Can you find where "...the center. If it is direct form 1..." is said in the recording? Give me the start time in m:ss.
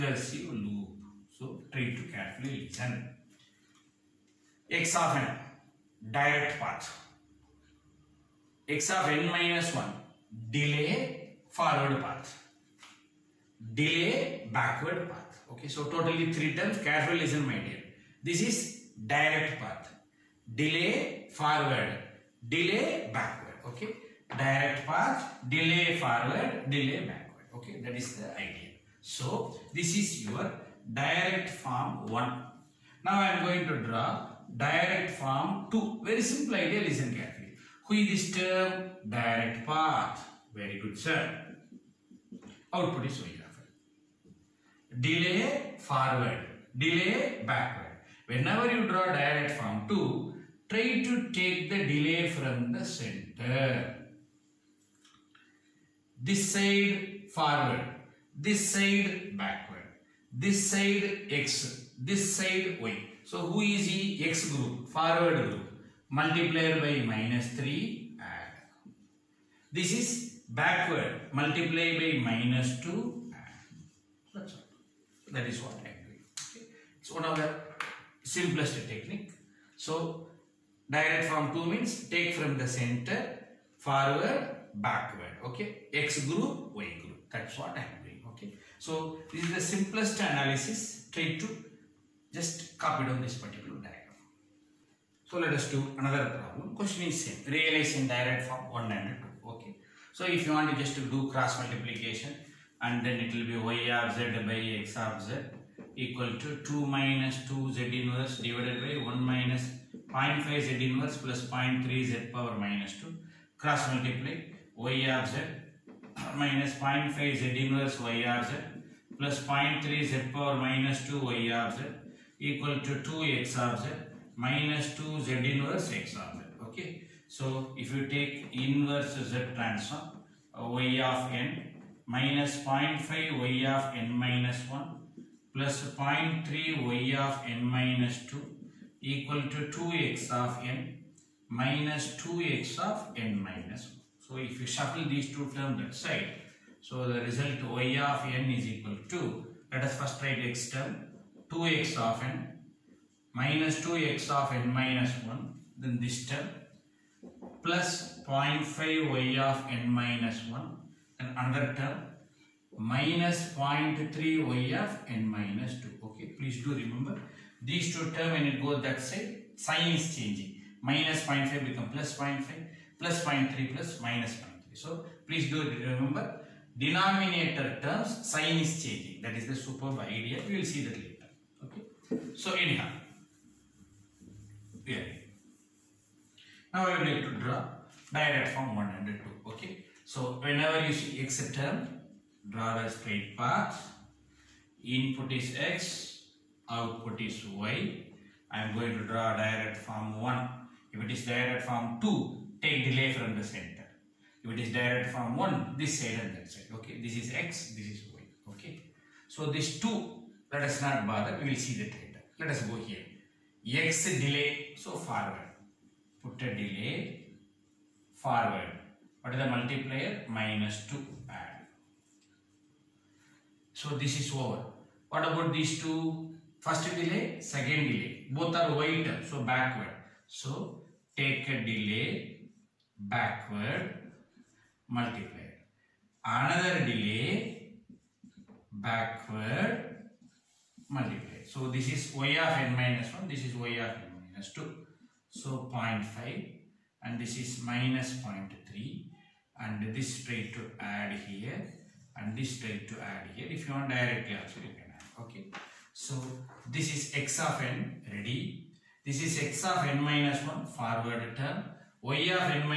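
3:23.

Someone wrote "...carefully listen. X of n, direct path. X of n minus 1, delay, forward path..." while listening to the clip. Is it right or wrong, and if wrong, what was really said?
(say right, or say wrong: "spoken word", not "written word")
right.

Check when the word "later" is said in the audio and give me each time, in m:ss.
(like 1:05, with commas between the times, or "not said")
3:00, 3:31.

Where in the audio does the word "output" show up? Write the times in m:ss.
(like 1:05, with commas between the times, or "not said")
0:42, 3:16.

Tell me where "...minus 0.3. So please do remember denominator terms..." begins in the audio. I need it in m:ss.
2:54.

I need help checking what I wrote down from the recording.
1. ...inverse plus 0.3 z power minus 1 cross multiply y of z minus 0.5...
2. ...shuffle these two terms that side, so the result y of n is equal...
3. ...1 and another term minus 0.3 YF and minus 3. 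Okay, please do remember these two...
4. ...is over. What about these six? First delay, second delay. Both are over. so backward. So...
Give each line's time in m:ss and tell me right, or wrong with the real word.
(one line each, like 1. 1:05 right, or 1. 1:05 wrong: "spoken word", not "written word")
1. 1:50 wrong: "2", not "1"
2. 2:24 right
3. 2:40 wrong: "2", not "3"
4. 3:44 wrong: "two", not "six".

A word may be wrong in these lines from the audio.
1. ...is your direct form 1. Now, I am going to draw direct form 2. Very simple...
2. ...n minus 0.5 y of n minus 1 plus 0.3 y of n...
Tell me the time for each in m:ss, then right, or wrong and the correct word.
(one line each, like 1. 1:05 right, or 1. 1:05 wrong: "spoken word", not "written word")
1. 0:29 right
2. 2:11 right.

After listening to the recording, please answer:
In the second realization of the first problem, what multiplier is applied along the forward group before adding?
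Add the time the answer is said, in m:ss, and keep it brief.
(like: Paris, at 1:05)
-3, at 1:07.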